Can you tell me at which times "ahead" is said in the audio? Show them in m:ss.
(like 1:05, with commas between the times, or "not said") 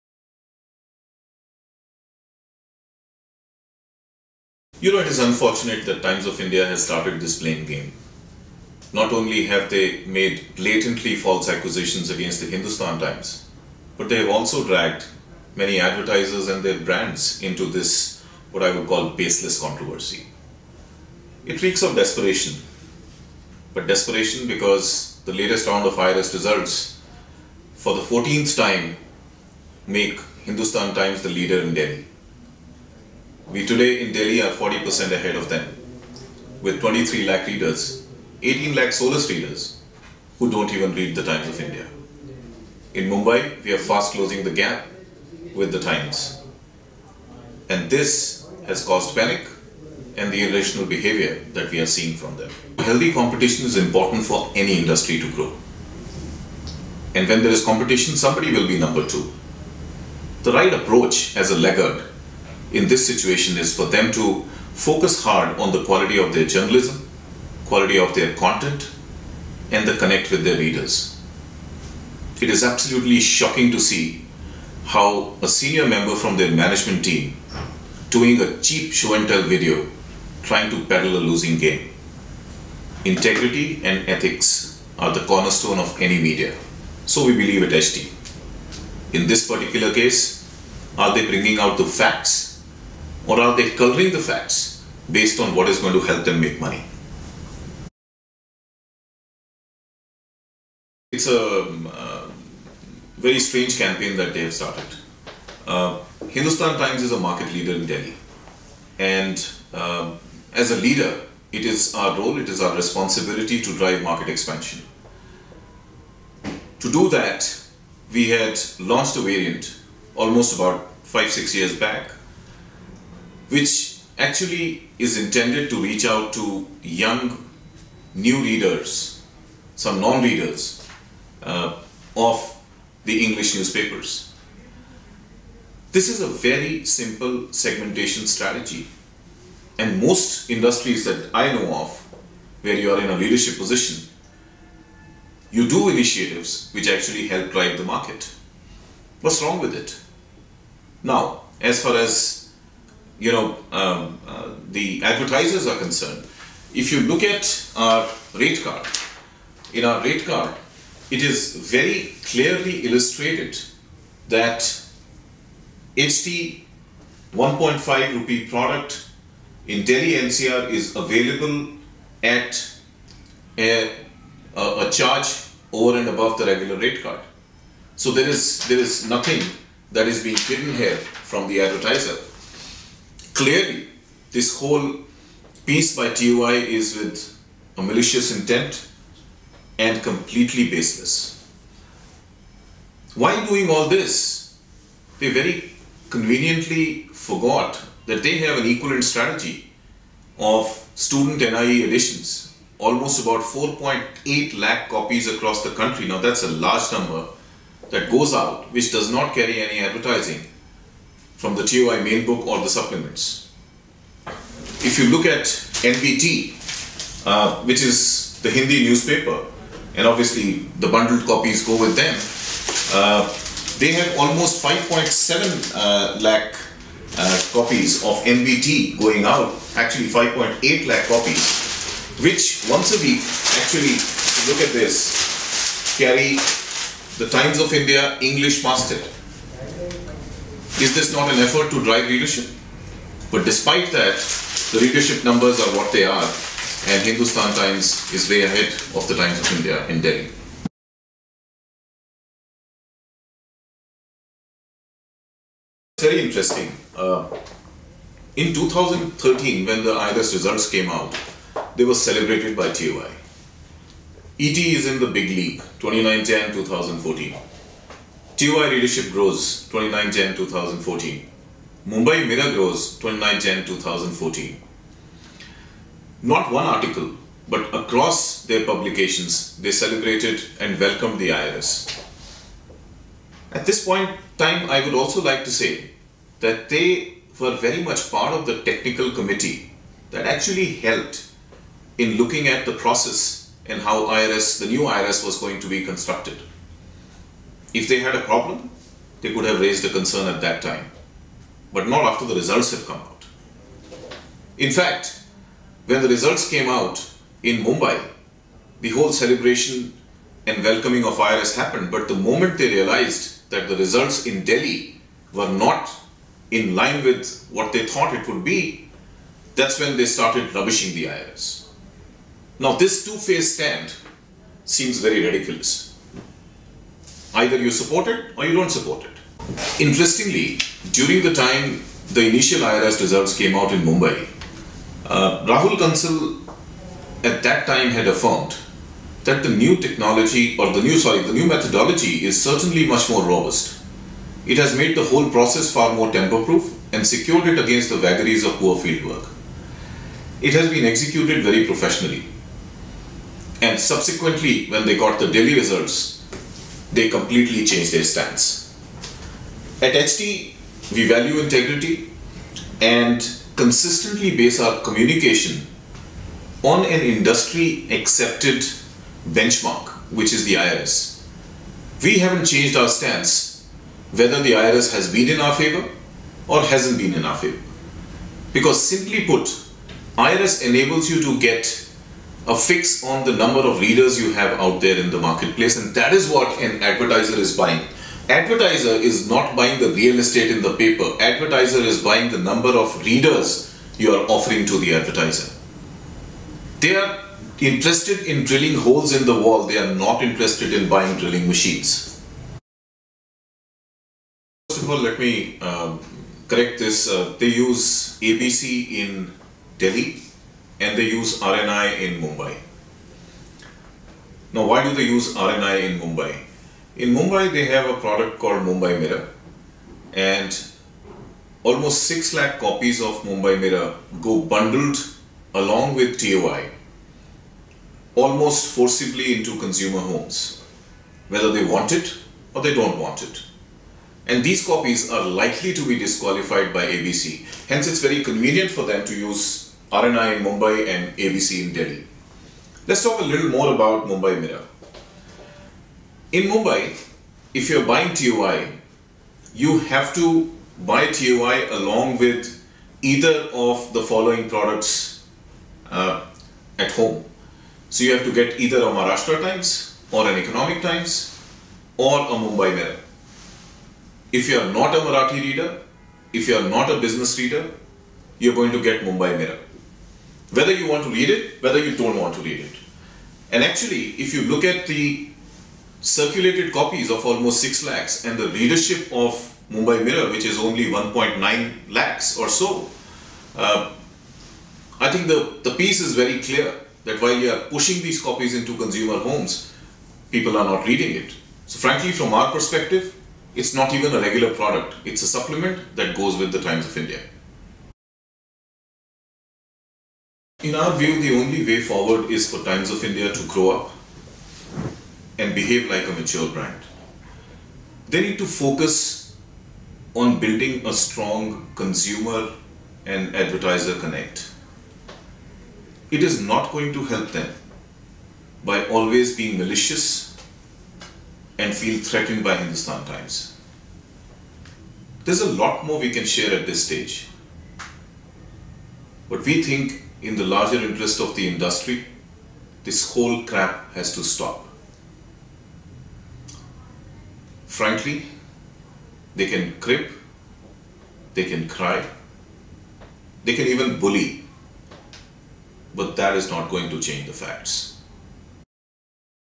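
0:35, 4:08.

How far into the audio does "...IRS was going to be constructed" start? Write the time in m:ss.
4:54.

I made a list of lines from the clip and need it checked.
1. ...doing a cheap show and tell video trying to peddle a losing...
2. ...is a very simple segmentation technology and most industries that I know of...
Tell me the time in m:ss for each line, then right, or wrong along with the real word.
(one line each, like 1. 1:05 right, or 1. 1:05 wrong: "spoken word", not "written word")
1. 1:18 right
2. 2:16 wrong: "strategy", not "technology".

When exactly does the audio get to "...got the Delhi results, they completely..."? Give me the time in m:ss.
5:54.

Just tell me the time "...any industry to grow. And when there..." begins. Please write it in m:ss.
0:54.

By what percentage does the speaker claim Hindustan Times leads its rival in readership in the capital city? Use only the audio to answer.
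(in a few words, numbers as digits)
40%.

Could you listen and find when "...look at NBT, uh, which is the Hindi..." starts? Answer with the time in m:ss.
3:35.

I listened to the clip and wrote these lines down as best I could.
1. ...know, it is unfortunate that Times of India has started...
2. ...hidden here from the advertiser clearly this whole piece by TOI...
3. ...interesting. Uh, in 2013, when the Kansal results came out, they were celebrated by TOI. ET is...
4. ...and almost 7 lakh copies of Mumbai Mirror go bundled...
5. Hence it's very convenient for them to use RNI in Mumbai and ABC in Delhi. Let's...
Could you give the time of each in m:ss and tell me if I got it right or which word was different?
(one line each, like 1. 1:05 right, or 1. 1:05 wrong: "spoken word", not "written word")
1. 0:04 right
2. 3:00 right
3. 4:16 wrong: "IRS", not "Kansal"
4. 7:00 wrong: "6", not "7"
5. 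7:17 right.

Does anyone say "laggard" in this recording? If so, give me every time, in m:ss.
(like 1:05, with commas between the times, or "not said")
1:01.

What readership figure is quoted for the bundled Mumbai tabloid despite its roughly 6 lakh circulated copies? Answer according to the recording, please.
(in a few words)
1.9 lakh.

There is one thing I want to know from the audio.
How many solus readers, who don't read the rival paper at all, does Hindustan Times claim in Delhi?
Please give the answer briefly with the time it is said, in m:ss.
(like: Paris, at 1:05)
18 lakh, at 0:38.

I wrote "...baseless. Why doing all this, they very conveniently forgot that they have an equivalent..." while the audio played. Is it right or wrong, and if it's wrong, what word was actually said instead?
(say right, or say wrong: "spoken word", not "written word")
right.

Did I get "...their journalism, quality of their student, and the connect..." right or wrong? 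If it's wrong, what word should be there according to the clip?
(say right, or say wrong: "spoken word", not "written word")
wrong: "content", not "student".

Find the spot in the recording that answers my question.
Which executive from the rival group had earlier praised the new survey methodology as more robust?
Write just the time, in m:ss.
5:35.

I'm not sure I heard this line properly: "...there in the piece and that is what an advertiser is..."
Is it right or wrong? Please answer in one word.
wrong.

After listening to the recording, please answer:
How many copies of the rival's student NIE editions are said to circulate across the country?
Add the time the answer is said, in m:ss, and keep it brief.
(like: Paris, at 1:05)
4.8 lakh, at 3:23.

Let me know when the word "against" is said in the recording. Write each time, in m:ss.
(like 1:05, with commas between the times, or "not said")
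0:12, 5:47.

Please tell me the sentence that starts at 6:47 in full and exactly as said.
Uh, they use ABC in Delhi and they use RNI in Mumbai.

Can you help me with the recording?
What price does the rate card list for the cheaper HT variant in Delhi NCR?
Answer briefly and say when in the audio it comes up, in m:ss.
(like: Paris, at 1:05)
1.5 rupee, at 2:47.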